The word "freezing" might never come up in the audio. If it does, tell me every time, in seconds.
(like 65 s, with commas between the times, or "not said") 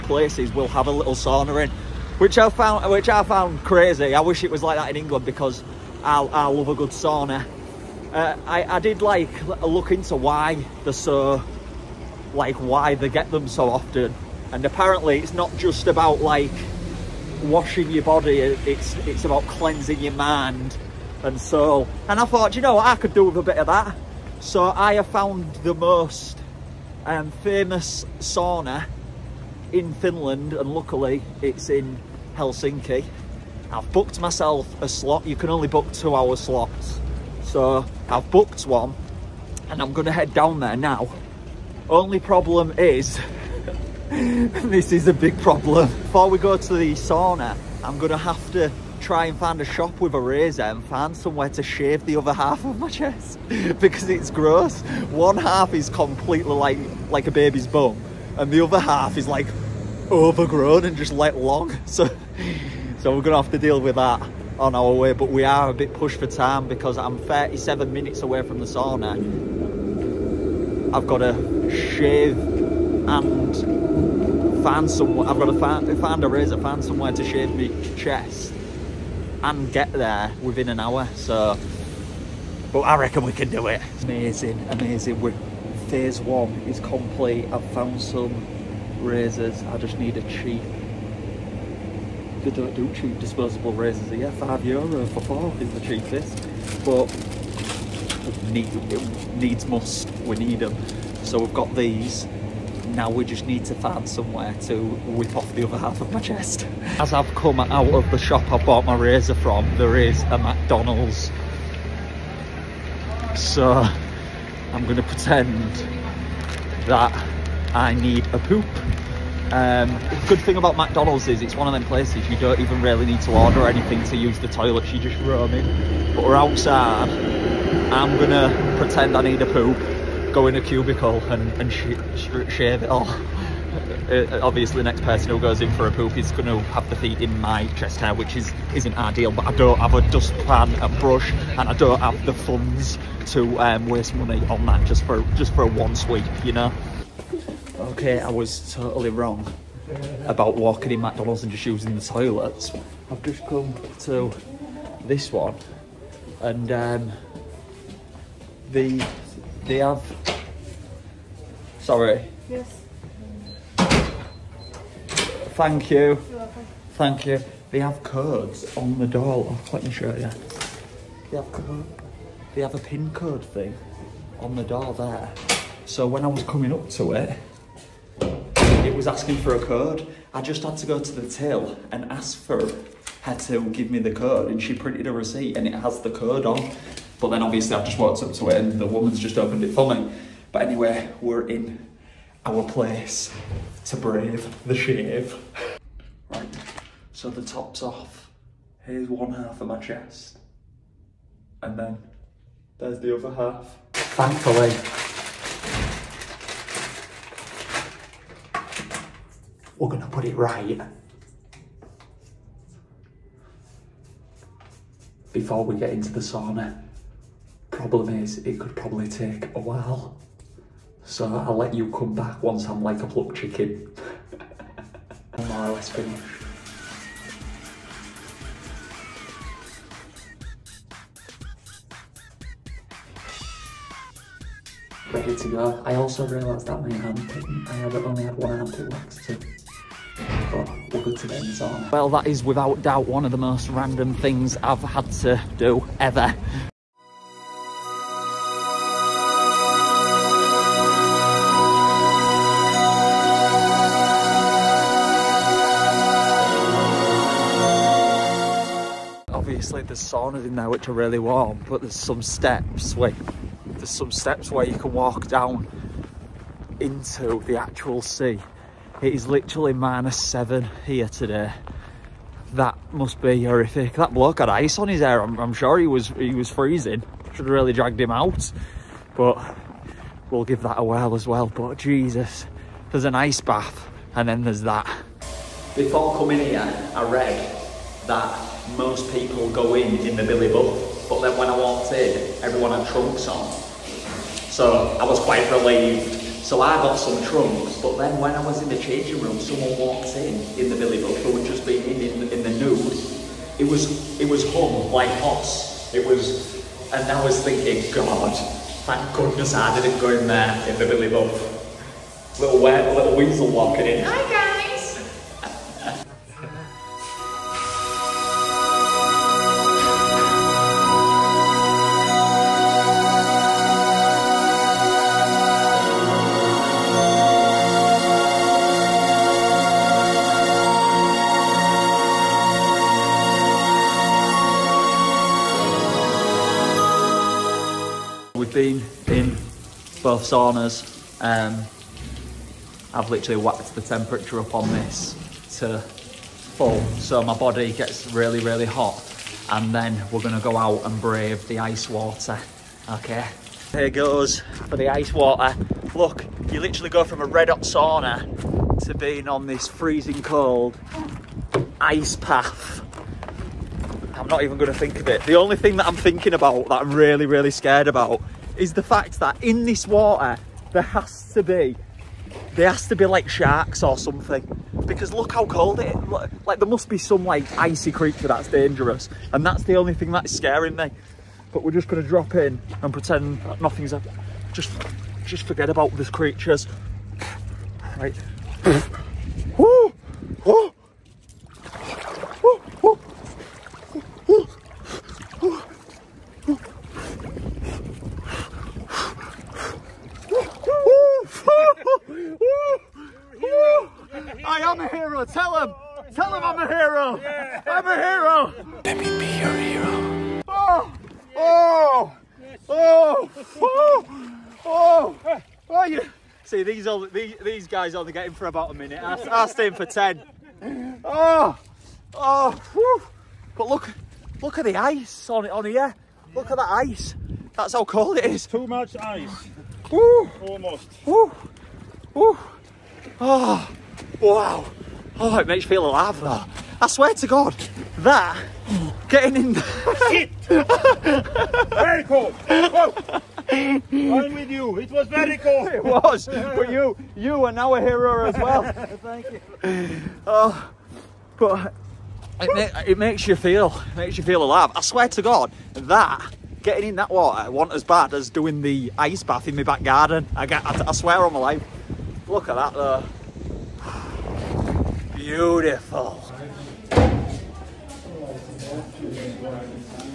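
276 s, 359 s.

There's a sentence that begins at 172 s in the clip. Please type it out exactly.
They have a pin code thing on the door there.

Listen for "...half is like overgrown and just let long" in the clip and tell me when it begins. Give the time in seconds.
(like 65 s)
58 s.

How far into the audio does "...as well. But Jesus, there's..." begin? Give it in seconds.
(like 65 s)
281 s.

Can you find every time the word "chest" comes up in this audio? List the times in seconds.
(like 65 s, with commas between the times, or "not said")
52 s, 77 s, 106 s, 137 s, 199 s.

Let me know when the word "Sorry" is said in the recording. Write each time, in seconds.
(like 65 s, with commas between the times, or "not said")
161 s.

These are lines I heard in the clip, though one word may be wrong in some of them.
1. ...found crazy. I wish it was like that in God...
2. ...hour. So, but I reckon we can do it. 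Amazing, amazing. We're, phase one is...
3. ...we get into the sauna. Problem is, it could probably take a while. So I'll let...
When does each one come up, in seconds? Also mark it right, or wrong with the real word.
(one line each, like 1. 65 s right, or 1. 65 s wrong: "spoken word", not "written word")
1. 3 s wrong: "England", not "God"
2. 80 s right
3. 215 s right.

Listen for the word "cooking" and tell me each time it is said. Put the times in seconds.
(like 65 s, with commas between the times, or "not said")
not said.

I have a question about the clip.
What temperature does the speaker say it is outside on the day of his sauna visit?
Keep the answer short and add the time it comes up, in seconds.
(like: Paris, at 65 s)
minus 7, at 269 s.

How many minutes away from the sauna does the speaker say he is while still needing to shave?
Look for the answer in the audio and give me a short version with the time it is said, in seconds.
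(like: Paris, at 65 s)
37, at 67 s.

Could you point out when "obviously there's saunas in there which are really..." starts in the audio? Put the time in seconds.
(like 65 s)
259 s.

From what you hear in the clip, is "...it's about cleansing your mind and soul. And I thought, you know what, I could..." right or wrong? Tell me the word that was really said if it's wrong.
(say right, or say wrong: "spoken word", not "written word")
right.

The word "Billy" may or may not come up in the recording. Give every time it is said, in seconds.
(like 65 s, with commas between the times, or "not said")
290 s, 300 s, 310 s.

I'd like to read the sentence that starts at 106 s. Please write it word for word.
As I've come out of the shop I bought my razor from, there is a McDonald's.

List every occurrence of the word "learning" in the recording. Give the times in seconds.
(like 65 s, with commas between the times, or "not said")
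not said.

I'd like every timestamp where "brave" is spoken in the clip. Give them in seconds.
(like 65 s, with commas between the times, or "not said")
193 s, 350 s.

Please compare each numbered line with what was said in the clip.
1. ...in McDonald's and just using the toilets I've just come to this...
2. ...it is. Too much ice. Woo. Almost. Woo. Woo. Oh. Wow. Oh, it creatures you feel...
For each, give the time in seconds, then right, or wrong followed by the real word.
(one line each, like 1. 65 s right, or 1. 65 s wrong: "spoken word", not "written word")
1. 150 s right
2. 428 s wrong: "makes", not "creatures".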